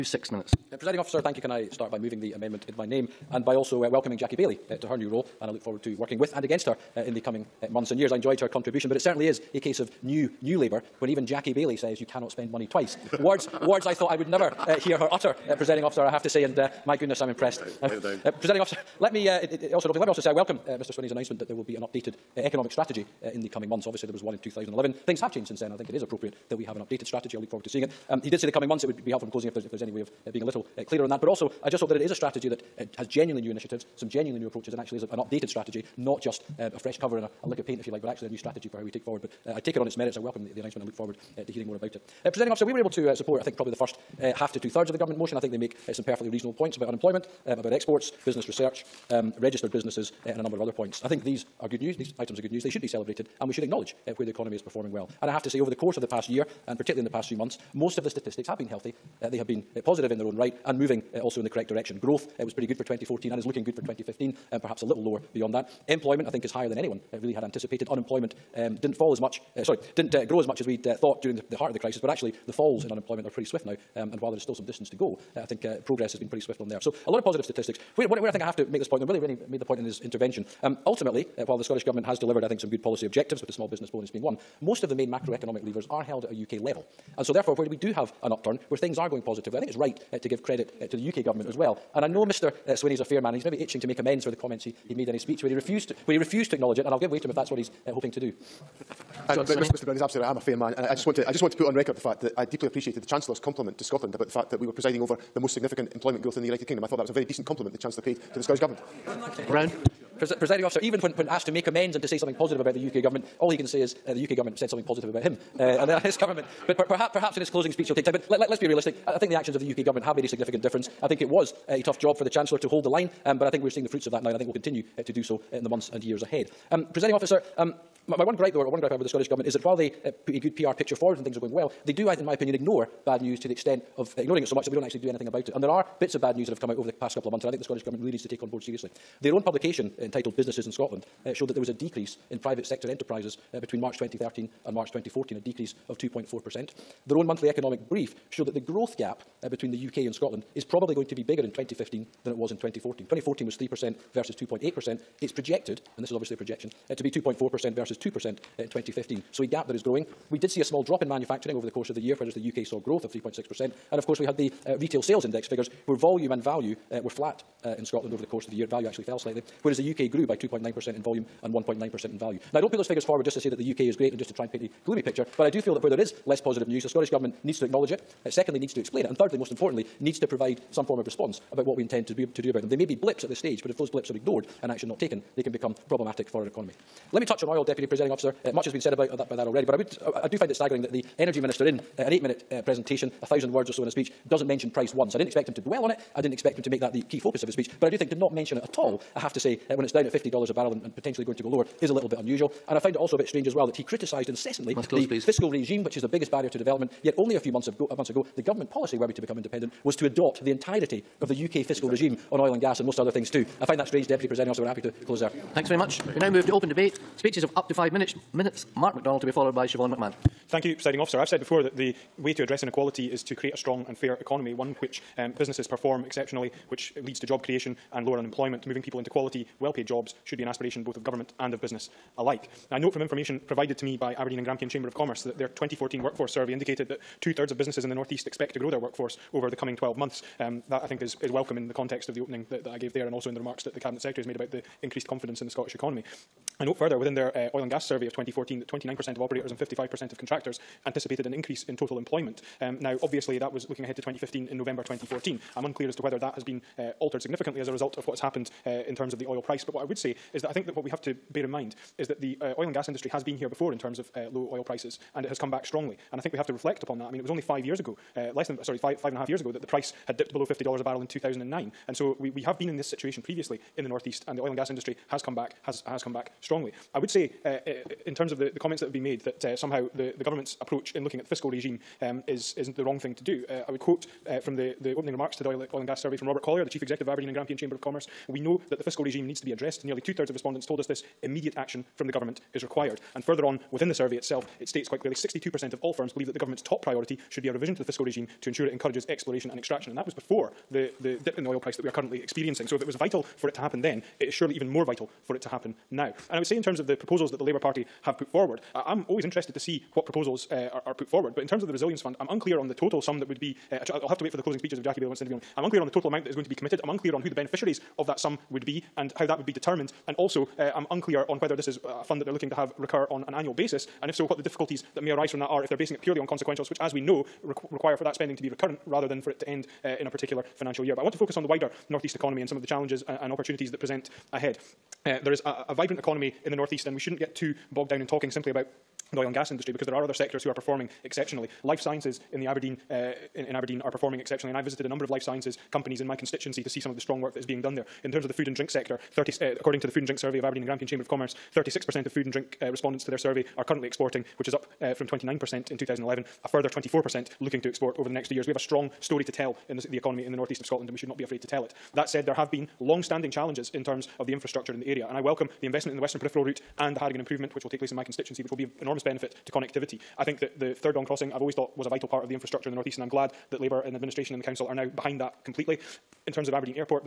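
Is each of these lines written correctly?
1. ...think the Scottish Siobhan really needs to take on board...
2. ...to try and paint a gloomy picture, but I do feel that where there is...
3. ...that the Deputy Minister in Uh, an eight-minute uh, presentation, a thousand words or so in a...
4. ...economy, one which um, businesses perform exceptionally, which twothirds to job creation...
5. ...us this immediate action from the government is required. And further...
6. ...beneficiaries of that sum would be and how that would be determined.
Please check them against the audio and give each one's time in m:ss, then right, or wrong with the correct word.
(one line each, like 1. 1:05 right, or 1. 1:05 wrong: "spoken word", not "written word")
1. 2:17 wrong: "Government", not "Siobhan"
2. 2:54 right
3. 3:10 wrong: "Energy", not "Deputy"
4. 3:44 wrong: "leads", not "twothirds"
5. 4:50 right
6. 5:17 right.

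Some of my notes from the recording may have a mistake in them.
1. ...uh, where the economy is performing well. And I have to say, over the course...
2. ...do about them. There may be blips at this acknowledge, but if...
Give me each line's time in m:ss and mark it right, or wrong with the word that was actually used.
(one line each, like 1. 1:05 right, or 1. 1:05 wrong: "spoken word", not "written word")
1. 0:54 right
2. 3:02 wrong: "stage", not "acknowledge".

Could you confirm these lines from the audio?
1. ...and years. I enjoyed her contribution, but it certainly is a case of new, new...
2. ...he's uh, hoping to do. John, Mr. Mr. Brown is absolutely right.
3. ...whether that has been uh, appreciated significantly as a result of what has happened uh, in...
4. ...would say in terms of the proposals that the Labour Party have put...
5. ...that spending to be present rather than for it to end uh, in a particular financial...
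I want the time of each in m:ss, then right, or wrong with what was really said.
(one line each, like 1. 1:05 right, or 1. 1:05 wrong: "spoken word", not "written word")
1. 0:07 right
2. 1:37 right
3. 4:16 wrong: "altered", not "appreciated"
4. 5:06 right
5. 5:28 wrong: "recurrent", not "present".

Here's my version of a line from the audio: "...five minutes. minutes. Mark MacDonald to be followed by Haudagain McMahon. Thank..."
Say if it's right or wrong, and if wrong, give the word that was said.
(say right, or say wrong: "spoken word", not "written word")
wrong: "Siobhan", not "Haudagain".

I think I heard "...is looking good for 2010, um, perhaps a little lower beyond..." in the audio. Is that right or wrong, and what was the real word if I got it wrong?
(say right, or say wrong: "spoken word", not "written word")
wrong: "2015", not "2010".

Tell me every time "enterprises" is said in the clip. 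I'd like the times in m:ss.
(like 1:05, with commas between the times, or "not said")
2:22.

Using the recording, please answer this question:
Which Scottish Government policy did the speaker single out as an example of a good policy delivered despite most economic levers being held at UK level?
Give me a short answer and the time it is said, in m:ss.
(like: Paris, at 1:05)
Small business bonus, at 1:23.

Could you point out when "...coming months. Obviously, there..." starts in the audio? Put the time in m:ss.
0:23.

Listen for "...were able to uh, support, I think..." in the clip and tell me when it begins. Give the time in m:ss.
0:42.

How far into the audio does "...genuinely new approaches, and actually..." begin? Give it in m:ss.
0:34.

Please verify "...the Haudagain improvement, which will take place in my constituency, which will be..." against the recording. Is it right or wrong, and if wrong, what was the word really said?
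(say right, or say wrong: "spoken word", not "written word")
right.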